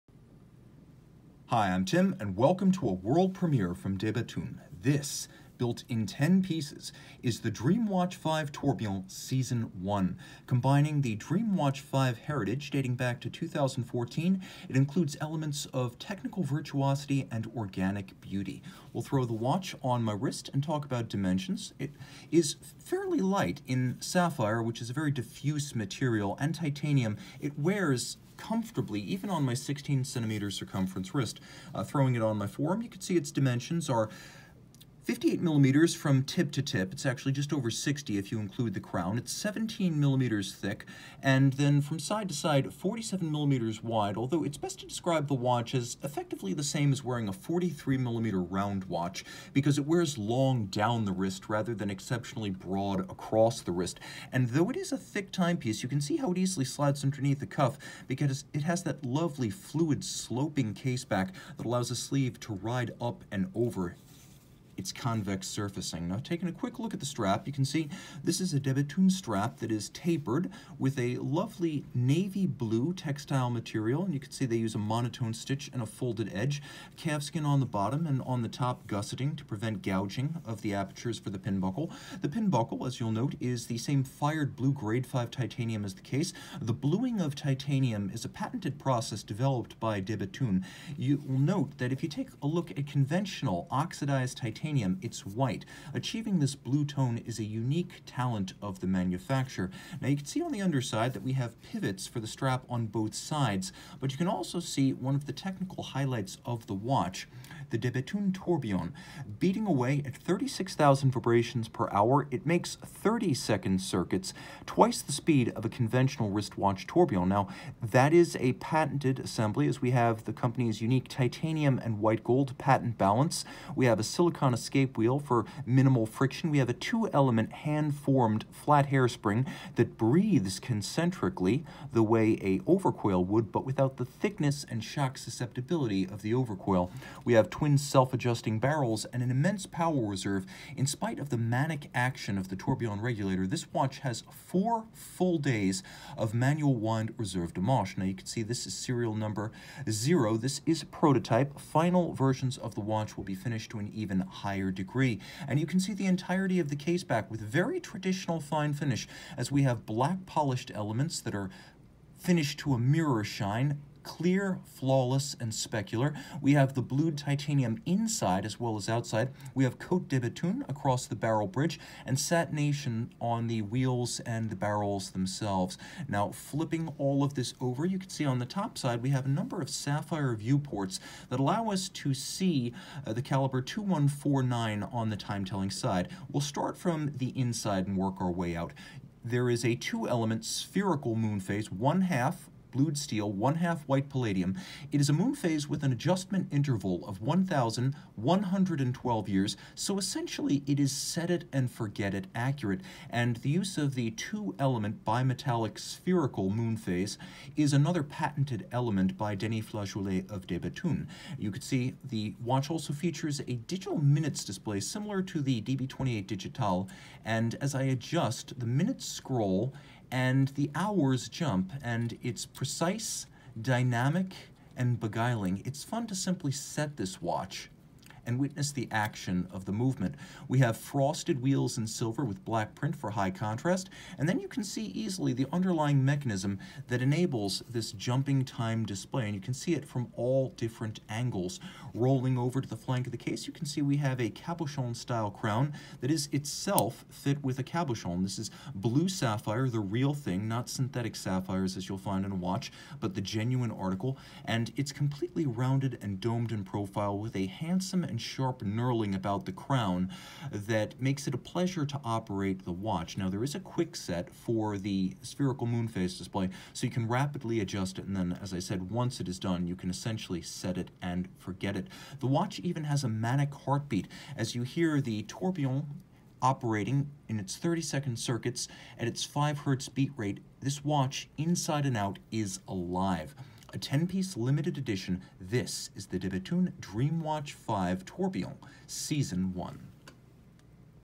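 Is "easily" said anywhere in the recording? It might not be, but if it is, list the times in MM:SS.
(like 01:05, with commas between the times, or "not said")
00:56, 03:54.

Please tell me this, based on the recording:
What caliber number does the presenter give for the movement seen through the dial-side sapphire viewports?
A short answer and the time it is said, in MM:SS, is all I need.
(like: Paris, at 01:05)
2149, at 03:03.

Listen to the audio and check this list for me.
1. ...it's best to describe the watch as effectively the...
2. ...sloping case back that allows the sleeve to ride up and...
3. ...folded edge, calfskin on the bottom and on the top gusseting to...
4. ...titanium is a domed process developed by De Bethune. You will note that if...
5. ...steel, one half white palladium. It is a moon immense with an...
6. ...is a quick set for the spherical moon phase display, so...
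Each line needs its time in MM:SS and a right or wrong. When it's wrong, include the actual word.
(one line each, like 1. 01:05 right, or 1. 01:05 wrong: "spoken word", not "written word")
1. 00:44 right
2. 01:00 right
3. 01:15 right
4. 01:27 wrong: "patented", not "domed"
5. 03:12 wrong: "phase", not "immense"
6. 04:23 right.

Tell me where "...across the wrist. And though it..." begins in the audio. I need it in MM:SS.
00:53.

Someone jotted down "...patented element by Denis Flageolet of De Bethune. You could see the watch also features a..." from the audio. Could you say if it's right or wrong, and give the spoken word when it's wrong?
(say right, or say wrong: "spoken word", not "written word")
right.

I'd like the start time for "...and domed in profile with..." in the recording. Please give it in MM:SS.
04:16.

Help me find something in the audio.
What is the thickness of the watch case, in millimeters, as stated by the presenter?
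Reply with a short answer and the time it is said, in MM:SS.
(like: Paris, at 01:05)
17, at 00:39.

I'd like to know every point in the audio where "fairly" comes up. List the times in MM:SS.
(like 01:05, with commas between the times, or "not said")
00:22.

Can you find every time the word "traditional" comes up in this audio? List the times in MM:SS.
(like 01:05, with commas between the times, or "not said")
02:37.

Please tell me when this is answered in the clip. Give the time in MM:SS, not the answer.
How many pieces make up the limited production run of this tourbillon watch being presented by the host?
00:06.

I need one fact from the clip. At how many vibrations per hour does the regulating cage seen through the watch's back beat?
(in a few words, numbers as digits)
36,000.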